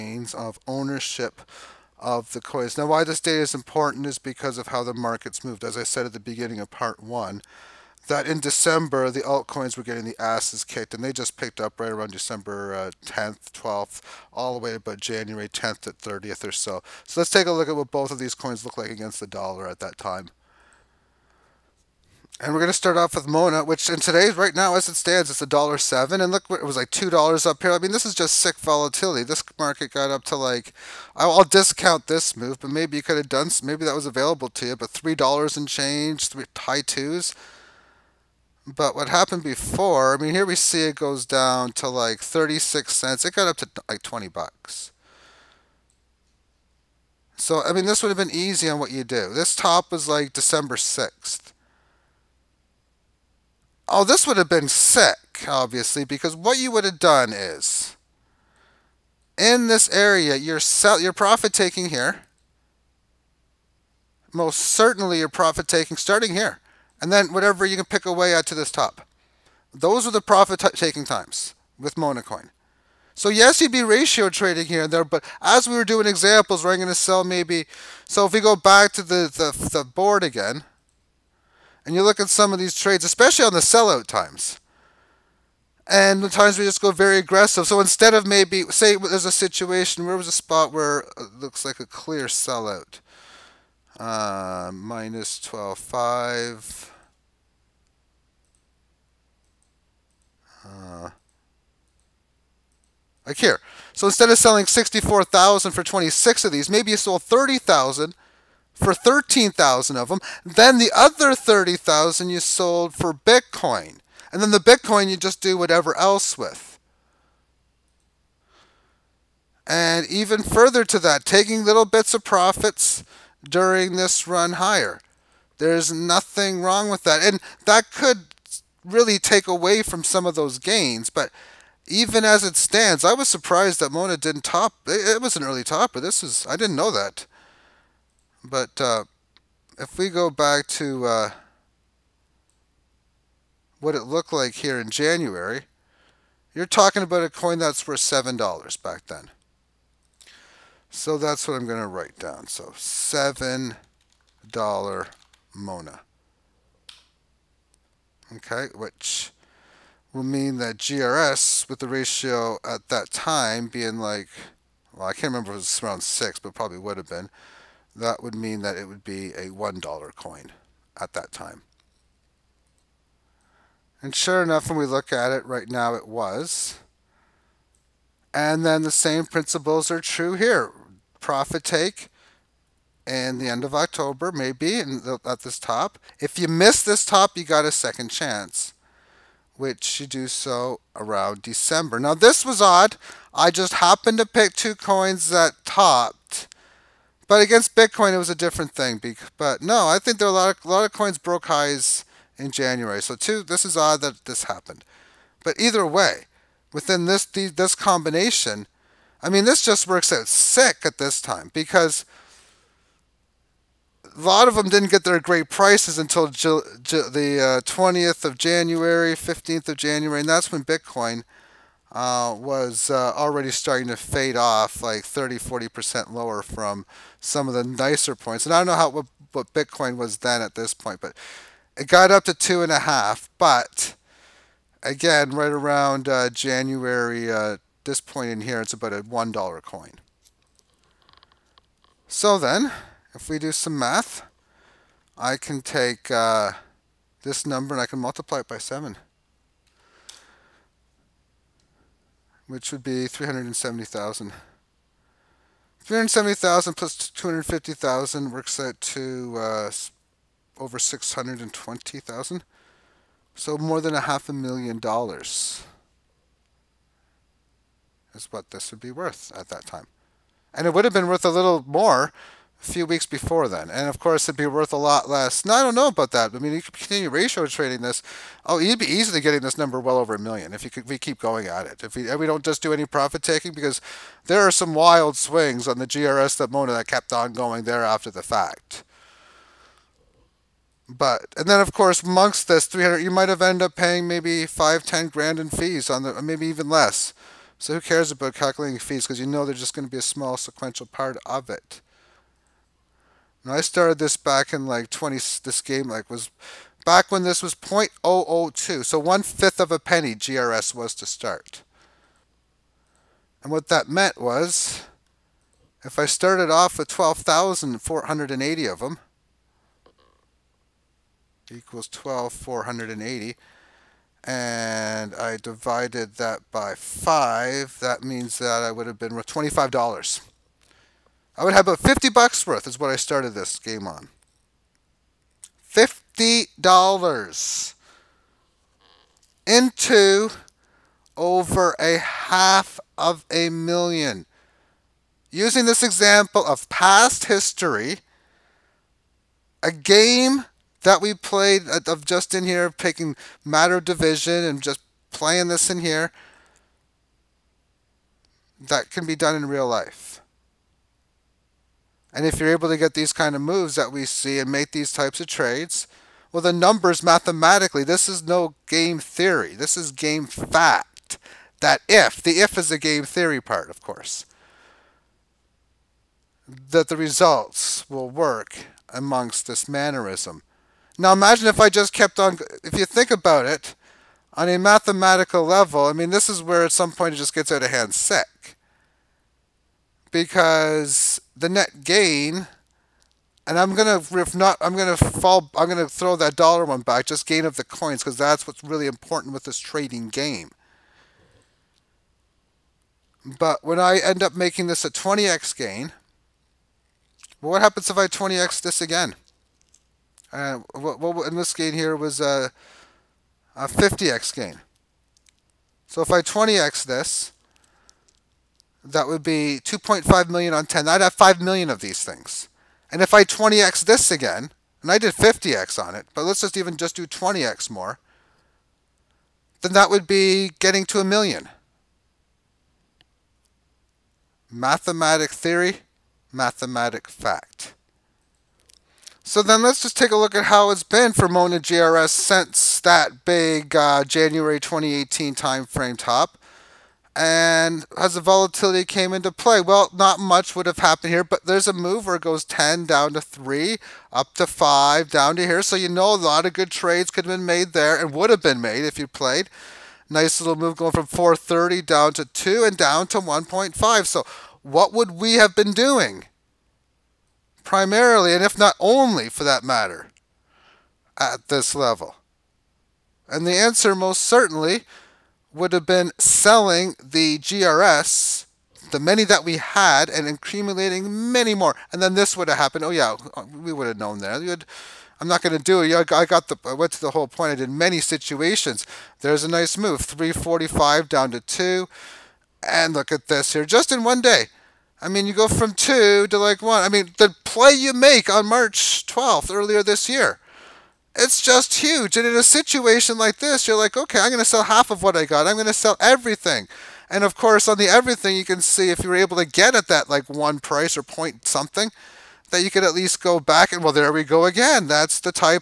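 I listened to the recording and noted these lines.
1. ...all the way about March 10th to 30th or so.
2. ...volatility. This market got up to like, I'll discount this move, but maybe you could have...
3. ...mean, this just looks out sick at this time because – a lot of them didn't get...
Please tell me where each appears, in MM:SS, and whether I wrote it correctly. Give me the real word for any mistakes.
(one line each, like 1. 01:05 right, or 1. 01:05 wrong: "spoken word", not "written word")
1. 00:14 wrong: "January", not "March"
2. 00:28 right
3. 03:29 wrong: "works", not "looks".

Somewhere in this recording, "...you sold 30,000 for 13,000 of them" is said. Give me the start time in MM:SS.
01:46.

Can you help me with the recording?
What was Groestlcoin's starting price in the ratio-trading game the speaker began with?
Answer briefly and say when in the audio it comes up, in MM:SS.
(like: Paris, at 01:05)
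0.002, at 05:07.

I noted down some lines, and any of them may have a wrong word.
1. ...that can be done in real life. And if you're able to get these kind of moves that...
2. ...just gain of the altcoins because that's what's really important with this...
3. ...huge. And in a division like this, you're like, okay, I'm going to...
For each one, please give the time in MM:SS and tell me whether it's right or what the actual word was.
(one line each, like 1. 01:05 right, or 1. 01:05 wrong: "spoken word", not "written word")
1. 05:58 right
2. 06:37 wrong: "coins", not "altcoins"
3. 08:21 wrong: "situation", not "division".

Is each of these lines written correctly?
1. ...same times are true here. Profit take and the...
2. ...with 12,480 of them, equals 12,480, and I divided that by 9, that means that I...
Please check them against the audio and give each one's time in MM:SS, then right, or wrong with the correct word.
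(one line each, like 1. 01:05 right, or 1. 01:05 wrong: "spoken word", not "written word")
1. 02:58 wrong: "principles", not "times"
2. 05:16 wrong: "5", not "9".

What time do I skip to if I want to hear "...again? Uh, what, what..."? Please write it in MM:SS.
06:48.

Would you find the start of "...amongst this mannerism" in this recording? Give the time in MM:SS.
06:18.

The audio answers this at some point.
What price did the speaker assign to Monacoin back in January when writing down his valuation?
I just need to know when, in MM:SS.
02:28.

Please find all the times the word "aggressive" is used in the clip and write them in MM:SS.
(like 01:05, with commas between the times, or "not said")
01:27.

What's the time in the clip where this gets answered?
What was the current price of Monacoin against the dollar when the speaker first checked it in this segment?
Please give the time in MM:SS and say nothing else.
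00:25.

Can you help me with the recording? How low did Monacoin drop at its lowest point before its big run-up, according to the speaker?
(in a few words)
36 cents.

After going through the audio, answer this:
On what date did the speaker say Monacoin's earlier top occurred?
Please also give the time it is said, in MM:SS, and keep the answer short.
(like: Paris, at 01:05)
December 6th, at 00:50.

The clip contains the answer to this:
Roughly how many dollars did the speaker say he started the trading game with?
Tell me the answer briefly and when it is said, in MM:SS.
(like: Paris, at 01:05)
50, at 05:31.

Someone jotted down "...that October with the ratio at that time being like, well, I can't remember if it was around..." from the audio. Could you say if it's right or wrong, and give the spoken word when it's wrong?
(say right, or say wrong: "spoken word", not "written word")
wrong: "GRS", not "October".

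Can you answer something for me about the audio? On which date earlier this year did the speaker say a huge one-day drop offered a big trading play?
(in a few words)
March 12th.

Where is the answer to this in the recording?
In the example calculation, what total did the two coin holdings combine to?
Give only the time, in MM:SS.
04:20.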